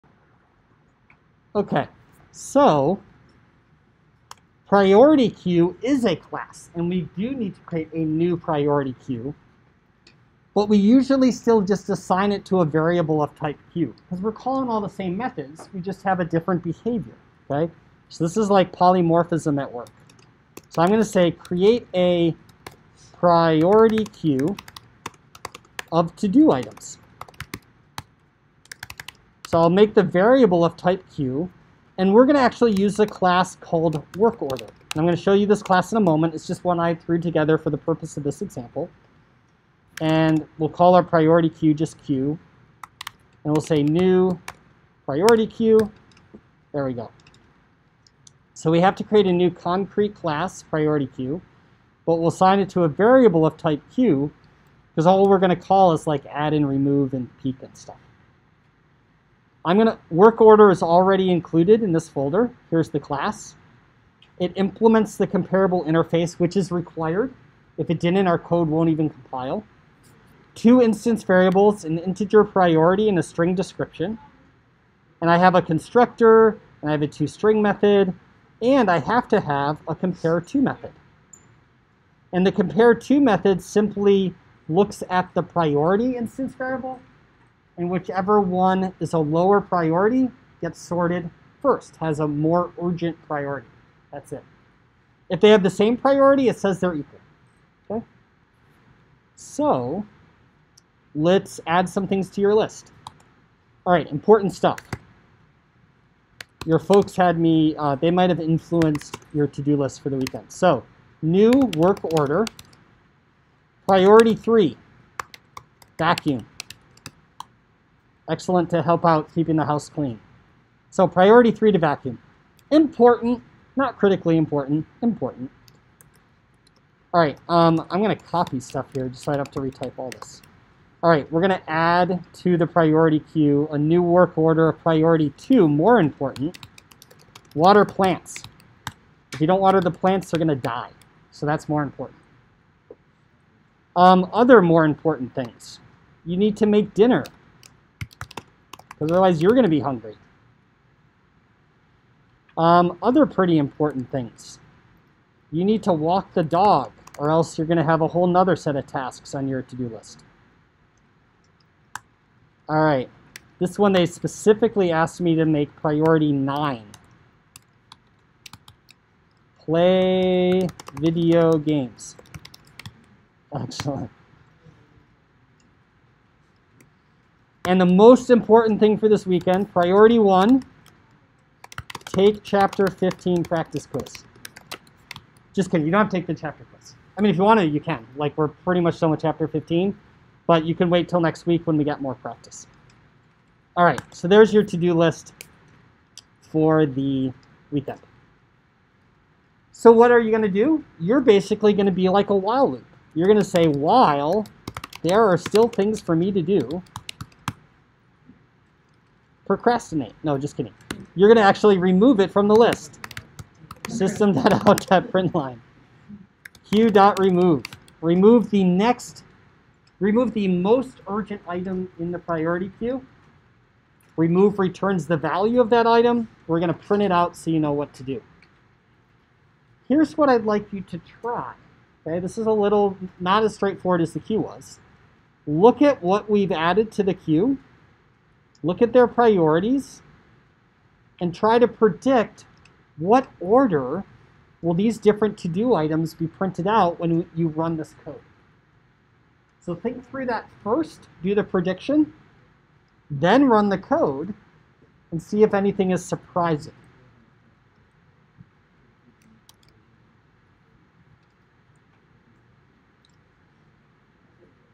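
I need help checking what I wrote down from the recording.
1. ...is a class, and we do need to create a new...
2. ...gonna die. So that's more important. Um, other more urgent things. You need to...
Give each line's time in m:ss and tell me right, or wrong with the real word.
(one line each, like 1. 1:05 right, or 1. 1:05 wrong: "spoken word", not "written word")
1. 0:05 right
2. 2:20 wrong: "important", not "urgent".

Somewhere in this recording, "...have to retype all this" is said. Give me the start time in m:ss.
2:09.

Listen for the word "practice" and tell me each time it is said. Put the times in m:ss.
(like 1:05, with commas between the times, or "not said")
3:03, 3:12.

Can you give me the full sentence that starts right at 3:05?
Just kidding, you don't have to take the chapter quiz.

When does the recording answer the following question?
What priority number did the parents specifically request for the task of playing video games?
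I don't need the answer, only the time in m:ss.
2:46.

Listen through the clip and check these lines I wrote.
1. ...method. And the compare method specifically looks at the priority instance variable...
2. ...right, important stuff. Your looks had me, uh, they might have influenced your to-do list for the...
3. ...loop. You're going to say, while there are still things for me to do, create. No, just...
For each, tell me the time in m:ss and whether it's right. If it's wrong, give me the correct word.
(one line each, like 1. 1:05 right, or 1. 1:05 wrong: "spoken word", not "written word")
1. 1:20 wrong: "simply", not "specifically"
2. 1:43 wrong: "folks", not "looks"
3. 3:22 wrong: "procrastinate", not "create".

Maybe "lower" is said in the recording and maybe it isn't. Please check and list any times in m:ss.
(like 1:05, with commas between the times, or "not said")
1:29.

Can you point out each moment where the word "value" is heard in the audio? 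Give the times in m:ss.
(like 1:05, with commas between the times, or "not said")
3:45.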